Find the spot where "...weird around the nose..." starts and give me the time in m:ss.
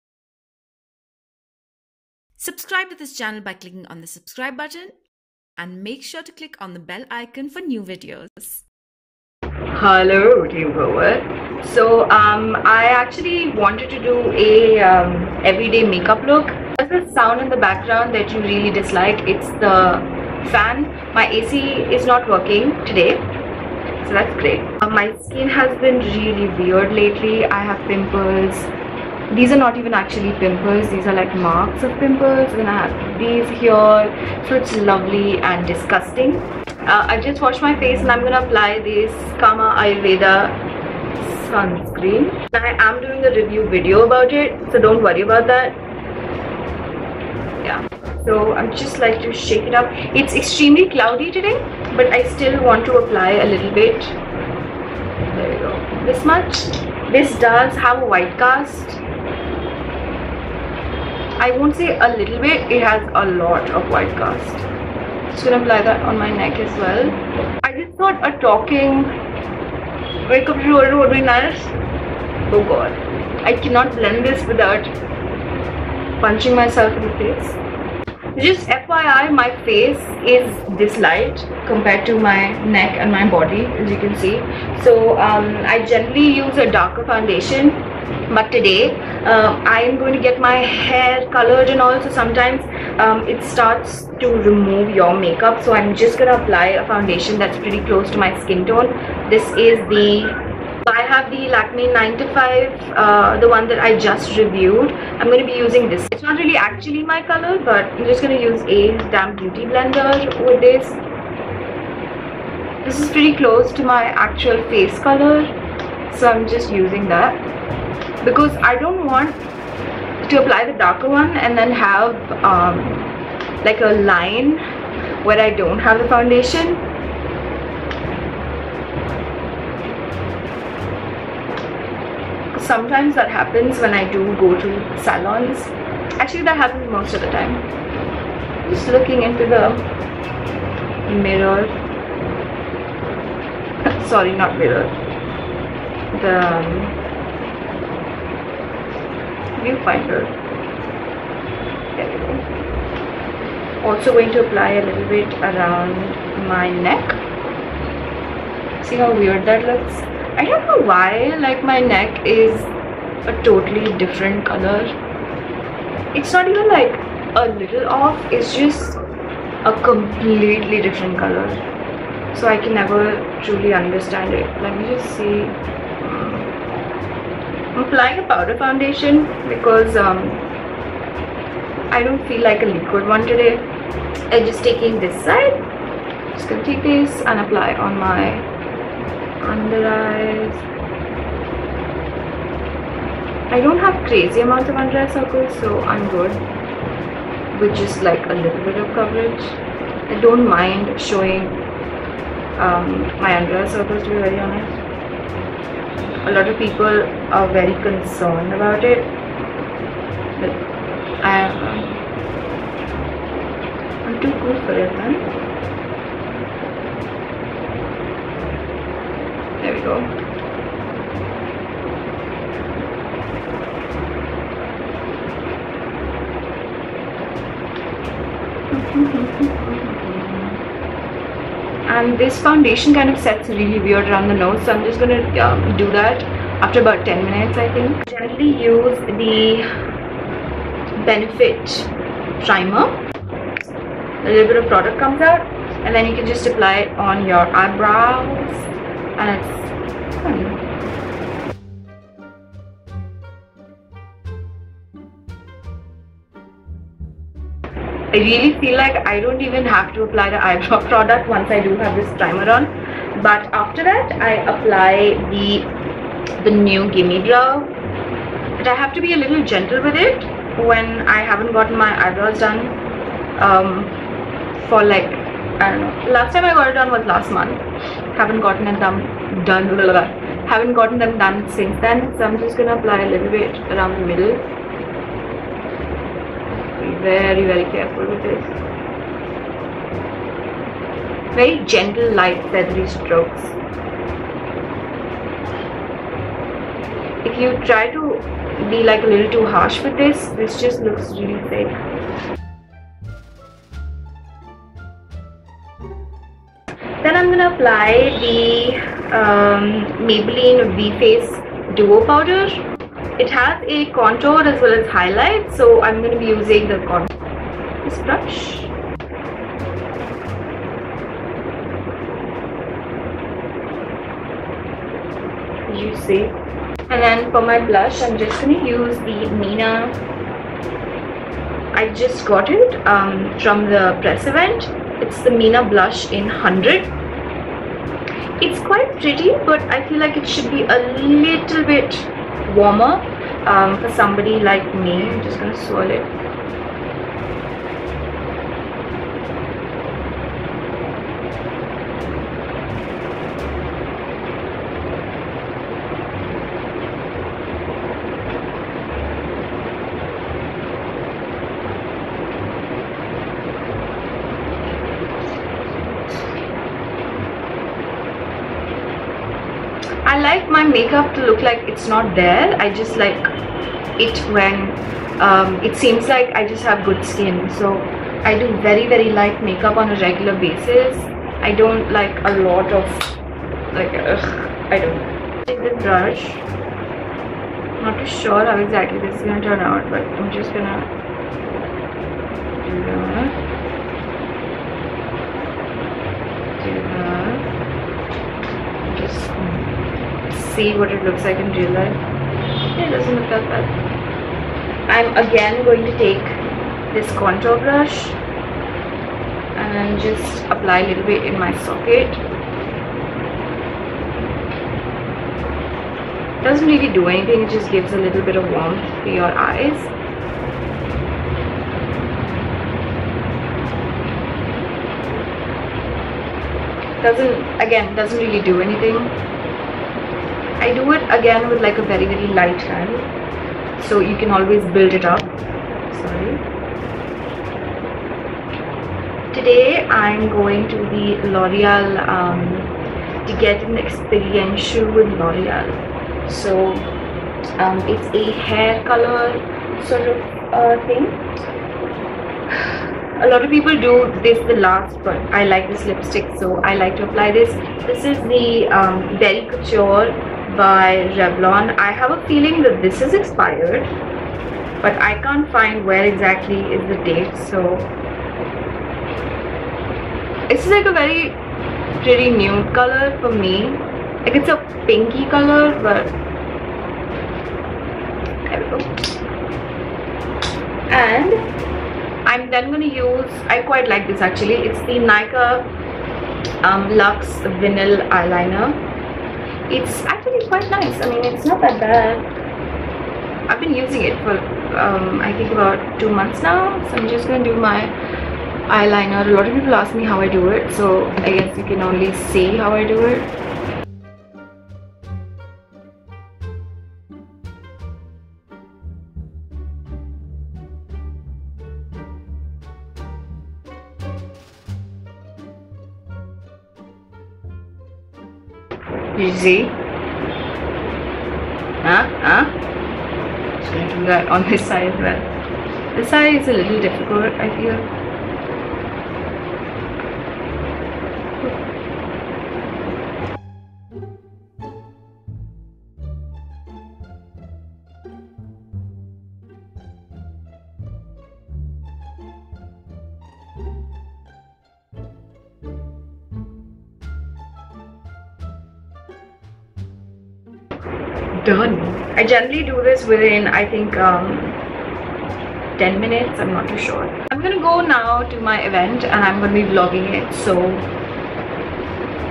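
3:53.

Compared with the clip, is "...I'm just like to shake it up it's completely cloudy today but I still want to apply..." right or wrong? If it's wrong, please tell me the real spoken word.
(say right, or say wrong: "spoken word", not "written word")
wrong: "extremely", not "completely".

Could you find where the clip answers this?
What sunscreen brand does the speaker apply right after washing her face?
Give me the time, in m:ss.
0:39.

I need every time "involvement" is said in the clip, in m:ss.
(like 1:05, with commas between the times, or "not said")
not said.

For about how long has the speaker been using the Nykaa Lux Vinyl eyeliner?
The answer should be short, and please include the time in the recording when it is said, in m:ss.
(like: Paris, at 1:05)
2 months, at 8:15.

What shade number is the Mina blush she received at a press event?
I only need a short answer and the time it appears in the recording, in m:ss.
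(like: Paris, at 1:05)
100, at 5:36.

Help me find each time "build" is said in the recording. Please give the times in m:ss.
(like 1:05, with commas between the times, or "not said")
7:14.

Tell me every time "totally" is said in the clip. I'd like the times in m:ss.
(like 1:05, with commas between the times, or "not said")
2:43.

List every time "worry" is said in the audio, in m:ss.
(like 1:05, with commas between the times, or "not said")
0:45.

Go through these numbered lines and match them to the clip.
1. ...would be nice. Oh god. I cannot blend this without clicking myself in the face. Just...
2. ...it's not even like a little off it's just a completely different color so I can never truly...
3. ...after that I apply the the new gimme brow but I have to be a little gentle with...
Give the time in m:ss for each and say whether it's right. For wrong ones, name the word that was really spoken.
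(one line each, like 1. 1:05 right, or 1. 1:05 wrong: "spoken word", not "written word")
1. 1:10 wrong: "punching", not "clicking"
2. 2:46 right
3. 4:23 right.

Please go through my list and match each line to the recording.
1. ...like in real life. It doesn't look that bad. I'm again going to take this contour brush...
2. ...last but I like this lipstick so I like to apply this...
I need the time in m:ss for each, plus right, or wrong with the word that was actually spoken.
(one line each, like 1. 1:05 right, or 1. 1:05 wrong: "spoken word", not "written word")
1. 6:41 right
2. 7:34 right.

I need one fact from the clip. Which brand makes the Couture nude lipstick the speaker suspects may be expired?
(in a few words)
Revlon.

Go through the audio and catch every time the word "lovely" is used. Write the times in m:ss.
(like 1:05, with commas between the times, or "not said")
0:34.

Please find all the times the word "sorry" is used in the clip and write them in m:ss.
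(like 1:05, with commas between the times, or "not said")
2:24, 7:16.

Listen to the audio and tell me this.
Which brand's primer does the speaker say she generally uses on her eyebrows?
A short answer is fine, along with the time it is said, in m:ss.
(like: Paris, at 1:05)
Benefit, at 4:01.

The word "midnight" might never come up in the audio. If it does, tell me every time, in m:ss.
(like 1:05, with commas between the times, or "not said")
not said.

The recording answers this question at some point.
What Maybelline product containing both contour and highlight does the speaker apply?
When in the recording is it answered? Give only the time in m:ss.
5:10.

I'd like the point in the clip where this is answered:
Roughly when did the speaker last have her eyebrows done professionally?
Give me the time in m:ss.
4:37.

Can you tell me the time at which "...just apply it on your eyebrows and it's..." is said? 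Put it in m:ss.
4:06.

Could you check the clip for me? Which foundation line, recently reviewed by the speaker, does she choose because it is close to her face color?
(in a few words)
Lakme 9 to 5.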